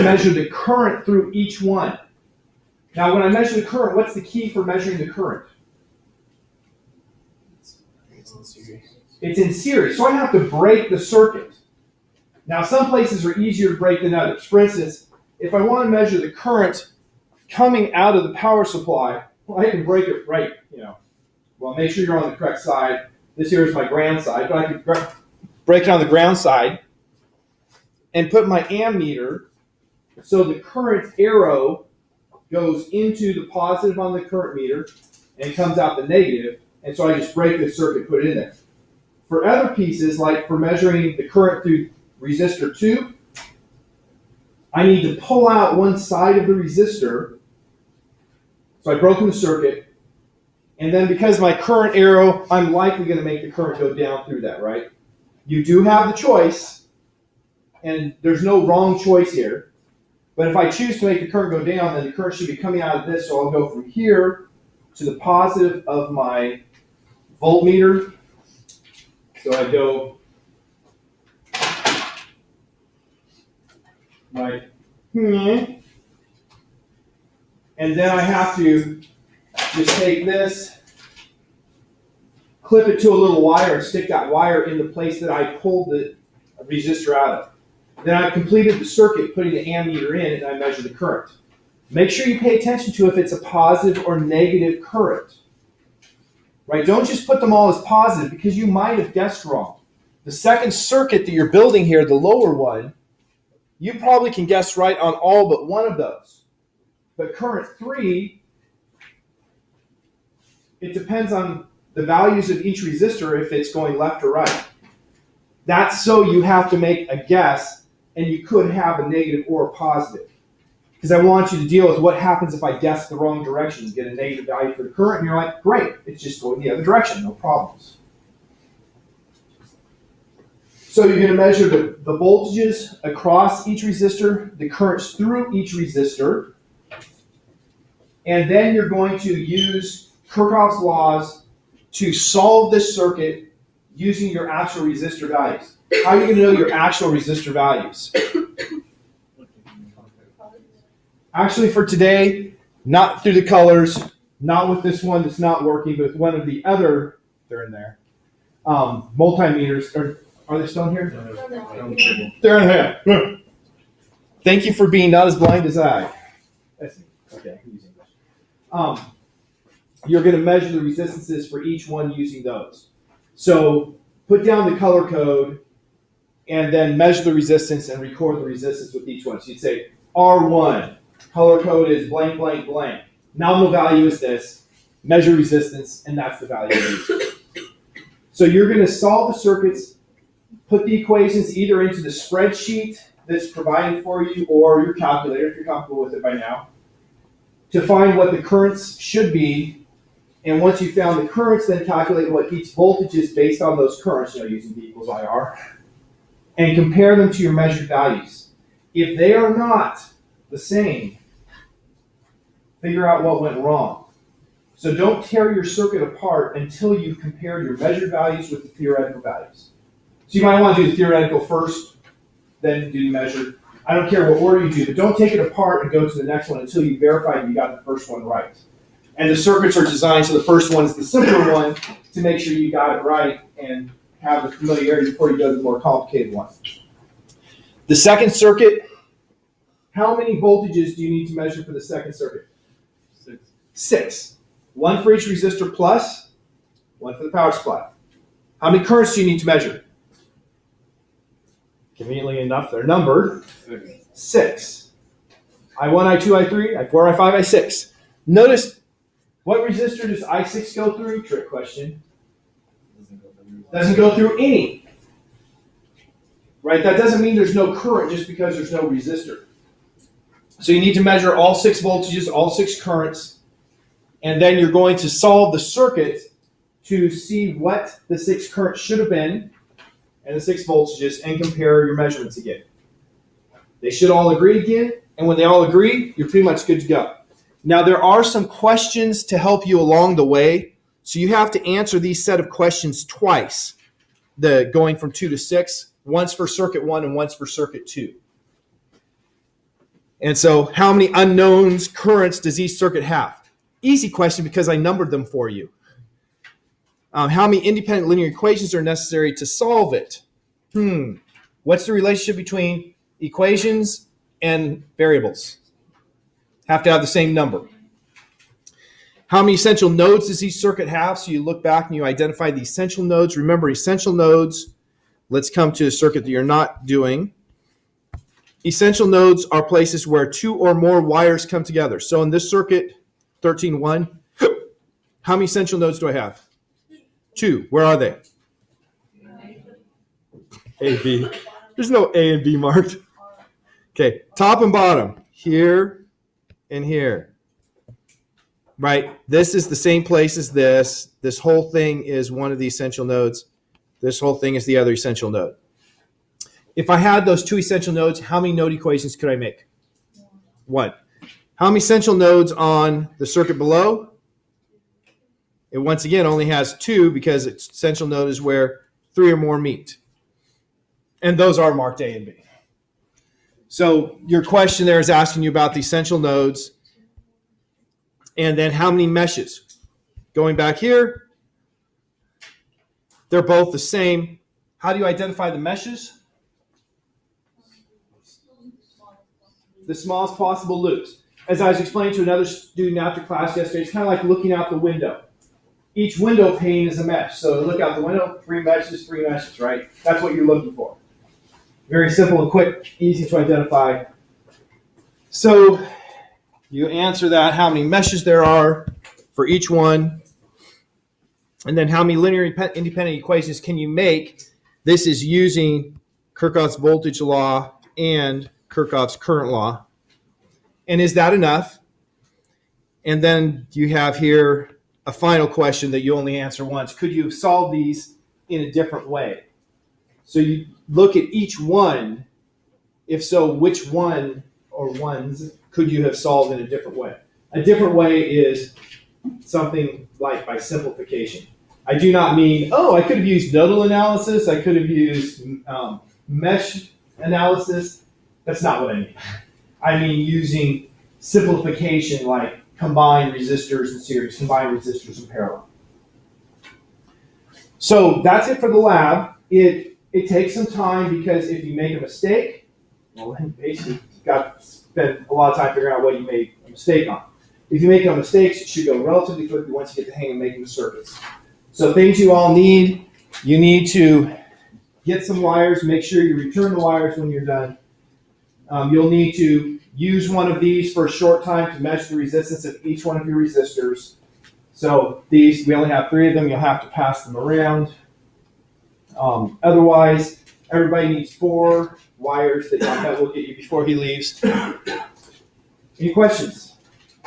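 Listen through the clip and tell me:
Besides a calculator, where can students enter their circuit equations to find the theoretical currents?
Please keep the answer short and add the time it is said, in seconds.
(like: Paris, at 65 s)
the spreadsheet, at 192 s.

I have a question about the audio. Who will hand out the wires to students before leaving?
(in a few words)
Yonkaz.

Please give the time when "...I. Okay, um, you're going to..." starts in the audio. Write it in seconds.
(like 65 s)
165 s.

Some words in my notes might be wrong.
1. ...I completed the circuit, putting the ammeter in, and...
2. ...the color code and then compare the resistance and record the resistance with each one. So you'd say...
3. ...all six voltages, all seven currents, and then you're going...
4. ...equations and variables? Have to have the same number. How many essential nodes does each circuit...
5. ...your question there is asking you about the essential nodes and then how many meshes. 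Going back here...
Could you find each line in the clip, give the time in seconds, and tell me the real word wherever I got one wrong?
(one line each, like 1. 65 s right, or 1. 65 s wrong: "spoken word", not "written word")
1. 88 s right
2. 174 s wrong: "measure", not "compare"
3. 271 s wrong: "six", not "seven"
4. 313 s right
5. 374 s right.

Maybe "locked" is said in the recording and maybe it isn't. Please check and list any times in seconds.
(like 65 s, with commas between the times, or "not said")
not said.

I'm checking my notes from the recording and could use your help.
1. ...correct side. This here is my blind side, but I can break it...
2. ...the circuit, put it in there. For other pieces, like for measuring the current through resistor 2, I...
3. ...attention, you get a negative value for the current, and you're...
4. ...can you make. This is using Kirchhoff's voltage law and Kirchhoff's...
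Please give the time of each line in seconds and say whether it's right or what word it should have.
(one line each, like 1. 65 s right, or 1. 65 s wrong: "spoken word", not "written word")
1. 22 s wrong: "ground", not "blind"
2. 37 s right
3. 123 s wrong: "direction", not "attention"
4. 413 s right.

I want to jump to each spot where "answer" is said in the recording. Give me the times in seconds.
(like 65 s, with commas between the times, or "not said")
291 s, 406 s, 426 s.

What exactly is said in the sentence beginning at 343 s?
Okay, top and bottom, here and here right?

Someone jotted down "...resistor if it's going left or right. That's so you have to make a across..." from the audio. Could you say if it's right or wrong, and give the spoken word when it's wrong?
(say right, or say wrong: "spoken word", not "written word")
wrong: "guess", not "across".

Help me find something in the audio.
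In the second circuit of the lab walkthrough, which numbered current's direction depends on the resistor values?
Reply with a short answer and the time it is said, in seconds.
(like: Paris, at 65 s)
current 3, at 107 s.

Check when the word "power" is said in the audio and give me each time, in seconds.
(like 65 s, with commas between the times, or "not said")
18 s, 247 s.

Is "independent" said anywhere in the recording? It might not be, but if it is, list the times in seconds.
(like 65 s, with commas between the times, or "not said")
307 s, 412 s.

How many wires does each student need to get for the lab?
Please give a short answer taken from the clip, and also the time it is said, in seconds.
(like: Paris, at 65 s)
4, at 491 s.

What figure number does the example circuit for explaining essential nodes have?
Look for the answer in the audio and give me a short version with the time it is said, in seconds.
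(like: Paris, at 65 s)
13.1, at 333 s.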